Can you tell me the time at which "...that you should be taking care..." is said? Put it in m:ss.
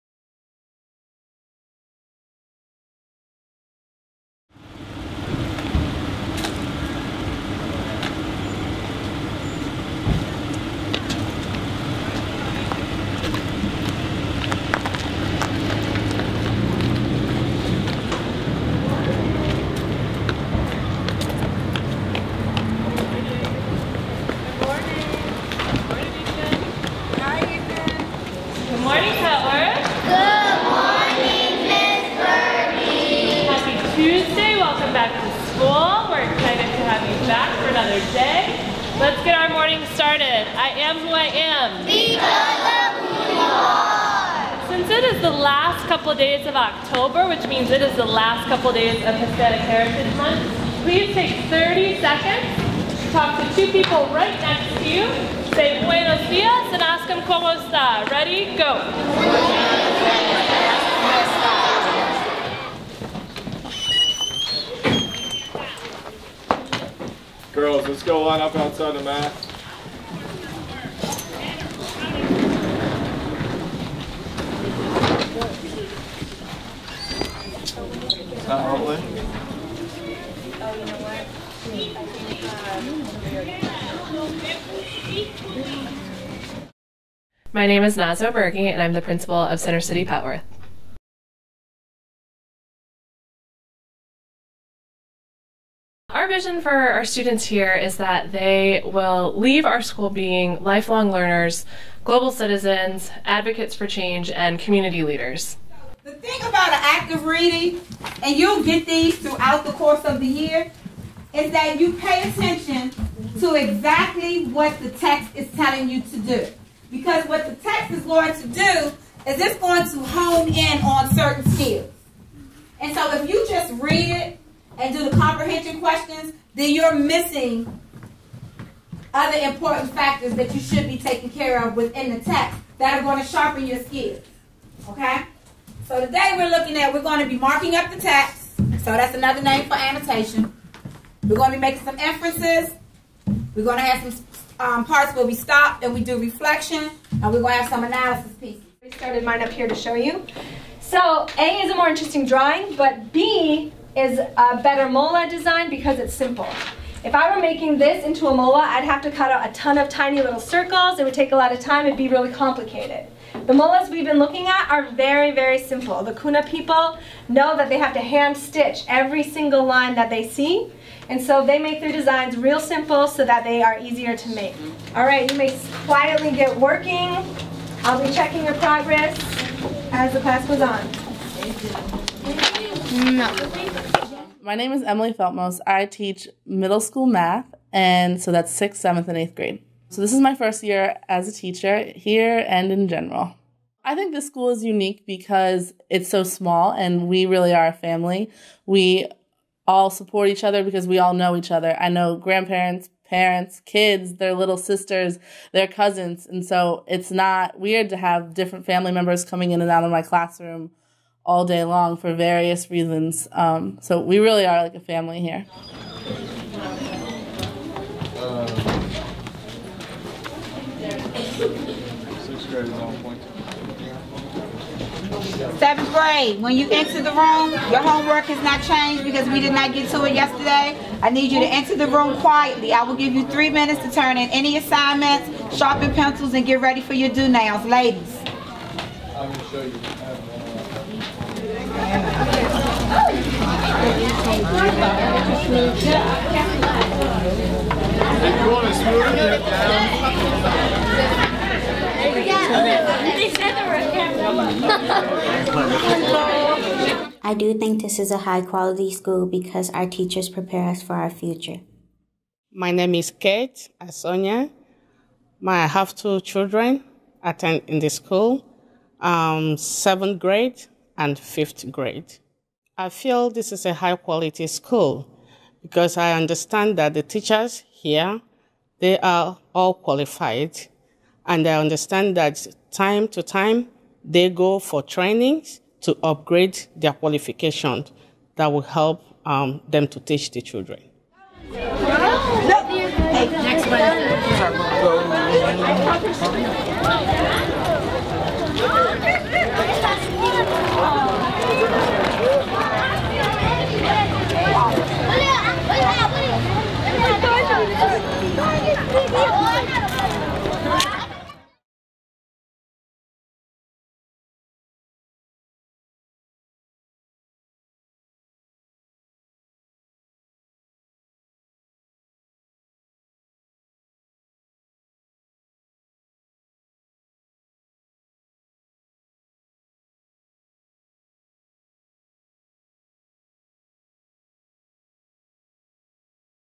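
2:10.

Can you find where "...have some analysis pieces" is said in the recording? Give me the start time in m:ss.
2:27.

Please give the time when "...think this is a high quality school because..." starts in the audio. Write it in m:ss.
4:17.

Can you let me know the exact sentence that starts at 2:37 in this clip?
If I were making this into a mola, I'd have to cut out a ton of tiny little circles.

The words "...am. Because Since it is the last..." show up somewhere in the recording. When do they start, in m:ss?
0:41.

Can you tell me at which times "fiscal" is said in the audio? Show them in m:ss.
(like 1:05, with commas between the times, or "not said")
not said.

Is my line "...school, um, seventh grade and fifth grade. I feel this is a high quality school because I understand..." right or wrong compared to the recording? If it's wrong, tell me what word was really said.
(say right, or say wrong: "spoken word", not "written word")
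right.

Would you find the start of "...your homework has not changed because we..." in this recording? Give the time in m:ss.
3:47.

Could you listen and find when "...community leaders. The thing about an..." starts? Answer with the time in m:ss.
1:44.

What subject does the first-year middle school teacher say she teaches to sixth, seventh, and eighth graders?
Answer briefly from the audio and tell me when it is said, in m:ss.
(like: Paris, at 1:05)
math, at 3:07.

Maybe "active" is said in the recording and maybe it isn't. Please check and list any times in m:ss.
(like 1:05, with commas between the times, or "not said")
1:46.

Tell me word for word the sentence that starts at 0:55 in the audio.
Say buenos dias and ask them cómo está.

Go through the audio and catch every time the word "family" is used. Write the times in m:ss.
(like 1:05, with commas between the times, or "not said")
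3:17, 3:28, 3:34.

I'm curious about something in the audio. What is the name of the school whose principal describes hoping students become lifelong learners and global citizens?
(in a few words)
Center City Petworth.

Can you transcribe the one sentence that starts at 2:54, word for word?
All right, you may quietly get working.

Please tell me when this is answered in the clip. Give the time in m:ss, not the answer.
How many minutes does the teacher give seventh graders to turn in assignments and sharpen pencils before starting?
3:53.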